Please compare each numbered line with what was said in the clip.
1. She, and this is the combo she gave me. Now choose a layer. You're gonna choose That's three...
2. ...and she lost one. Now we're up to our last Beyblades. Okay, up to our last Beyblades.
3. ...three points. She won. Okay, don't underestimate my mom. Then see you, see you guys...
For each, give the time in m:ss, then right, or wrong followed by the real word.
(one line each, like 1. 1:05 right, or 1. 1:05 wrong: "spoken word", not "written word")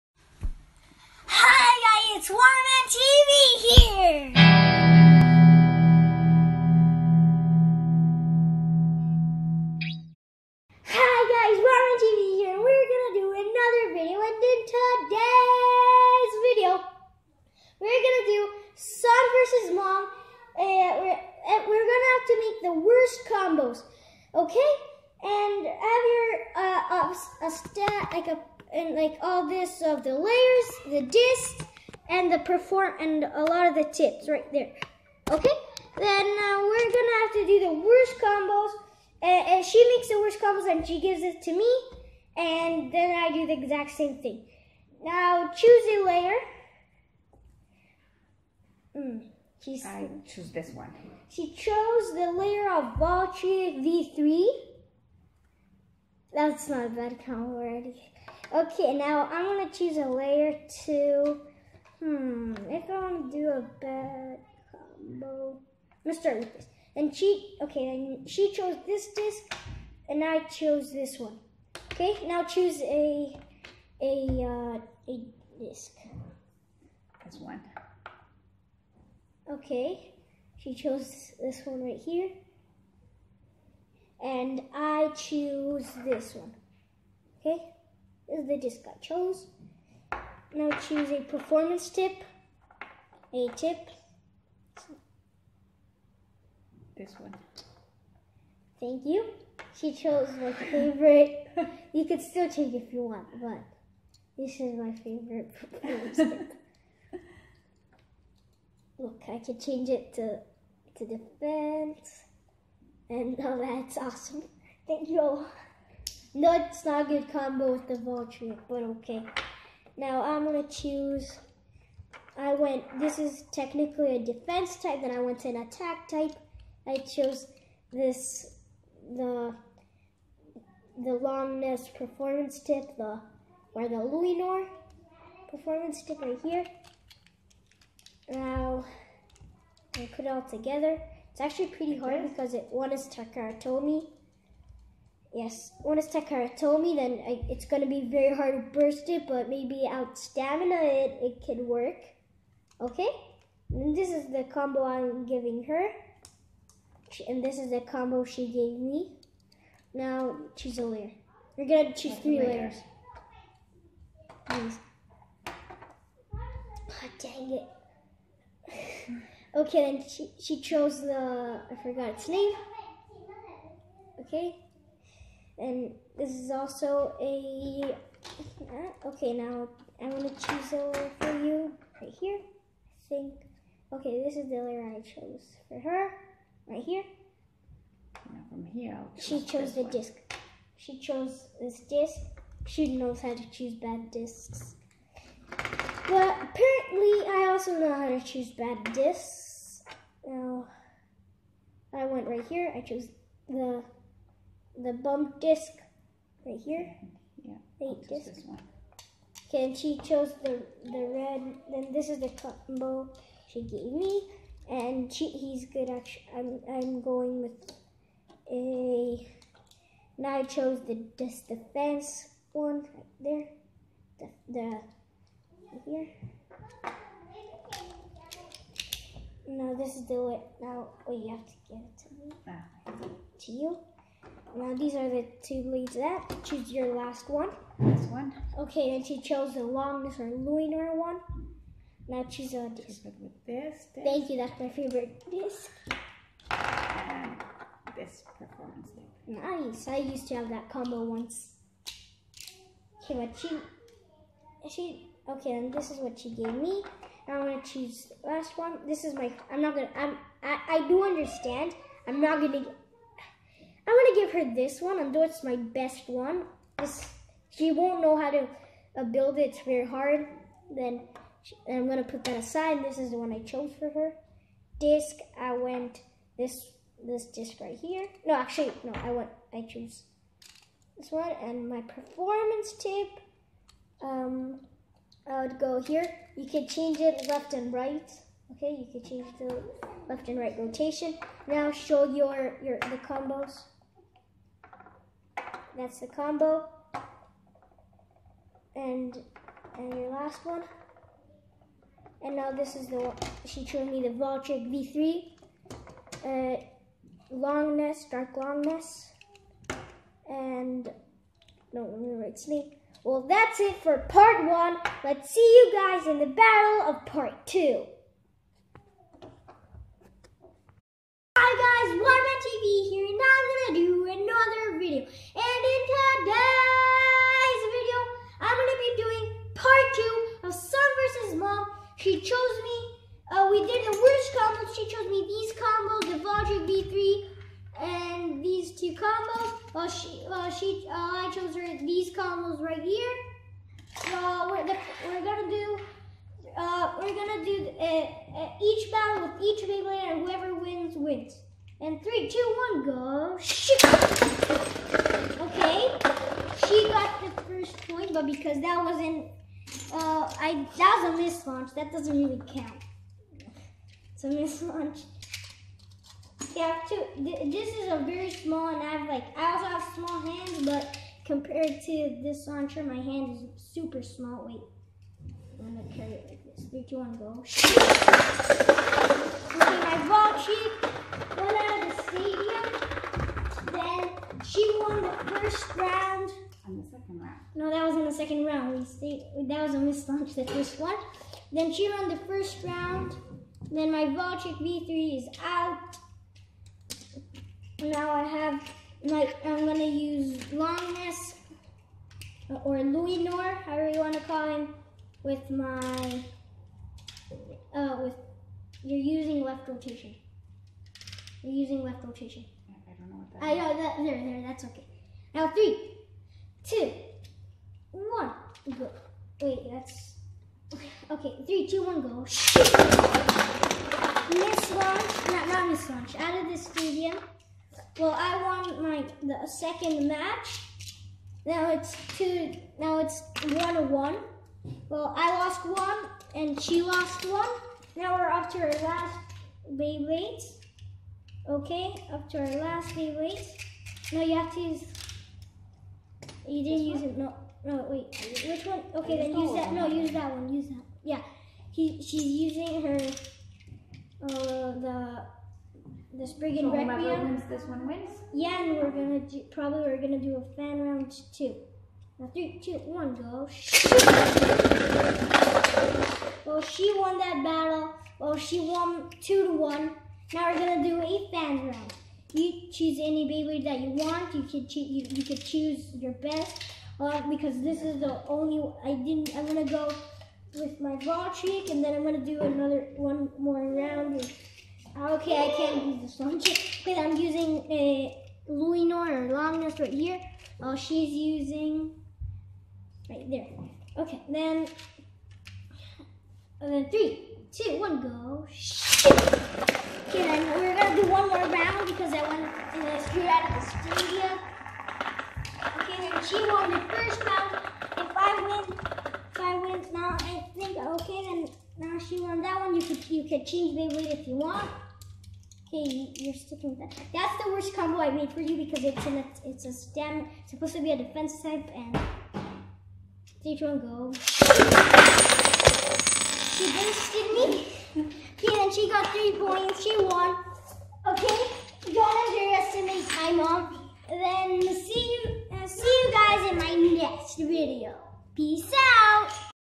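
1. 2:37 right
2. 7:16 right
3. 8:49 right.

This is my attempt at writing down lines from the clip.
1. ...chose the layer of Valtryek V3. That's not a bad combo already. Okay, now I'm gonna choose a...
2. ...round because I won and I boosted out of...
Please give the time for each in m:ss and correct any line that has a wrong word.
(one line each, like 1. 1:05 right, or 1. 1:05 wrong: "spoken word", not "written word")
1. 0:51 right
2. 8:21 wrong: "screwed", not "boosted".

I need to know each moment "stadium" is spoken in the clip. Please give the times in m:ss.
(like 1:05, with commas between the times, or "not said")
6:22, 7:06.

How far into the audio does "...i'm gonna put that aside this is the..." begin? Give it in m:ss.
4:31.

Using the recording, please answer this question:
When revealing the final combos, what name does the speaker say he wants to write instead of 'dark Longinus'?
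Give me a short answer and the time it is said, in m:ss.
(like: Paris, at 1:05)
snake, at 5:12.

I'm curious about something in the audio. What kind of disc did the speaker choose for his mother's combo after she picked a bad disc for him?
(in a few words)
bump disc.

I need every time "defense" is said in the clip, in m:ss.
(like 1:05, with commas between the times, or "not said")
1:51, 2:04, 3:41, 8:40.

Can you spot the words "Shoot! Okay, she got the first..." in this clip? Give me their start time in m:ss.
5:53.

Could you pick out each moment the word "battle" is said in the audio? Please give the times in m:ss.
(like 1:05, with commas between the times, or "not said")
5:16, 5:48, 7:47.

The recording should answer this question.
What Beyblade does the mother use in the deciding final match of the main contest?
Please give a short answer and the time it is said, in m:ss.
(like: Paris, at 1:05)
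Requiem, at 7:36.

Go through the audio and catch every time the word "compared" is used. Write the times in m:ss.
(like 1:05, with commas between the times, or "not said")
6:11.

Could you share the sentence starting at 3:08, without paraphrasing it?
Now from here, she chose the one.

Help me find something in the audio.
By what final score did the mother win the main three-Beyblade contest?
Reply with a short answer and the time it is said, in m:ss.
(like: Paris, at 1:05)
2 to 1, at 7:49.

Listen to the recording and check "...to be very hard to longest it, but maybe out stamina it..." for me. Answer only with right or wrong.
wrong.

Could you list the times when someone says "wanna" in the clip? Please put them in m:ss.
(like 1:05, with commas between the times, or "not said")
1:03.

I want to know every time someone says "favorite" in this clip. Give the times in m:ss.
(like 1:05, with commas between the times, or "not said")
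1:40, 1:44, 4:04.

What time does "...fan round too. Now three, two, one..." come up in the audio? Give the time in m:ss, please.
7:40.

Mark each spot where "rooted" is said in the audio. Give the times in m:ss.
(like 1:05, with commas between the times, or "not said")
not said.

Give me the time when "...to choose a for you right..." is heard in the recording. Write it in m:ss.
3:00.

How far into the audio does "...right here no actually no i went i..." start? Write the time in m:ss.
4:37.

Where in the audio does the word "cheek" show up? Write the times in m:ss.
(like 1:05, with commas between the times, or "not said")
6:20, 8:01.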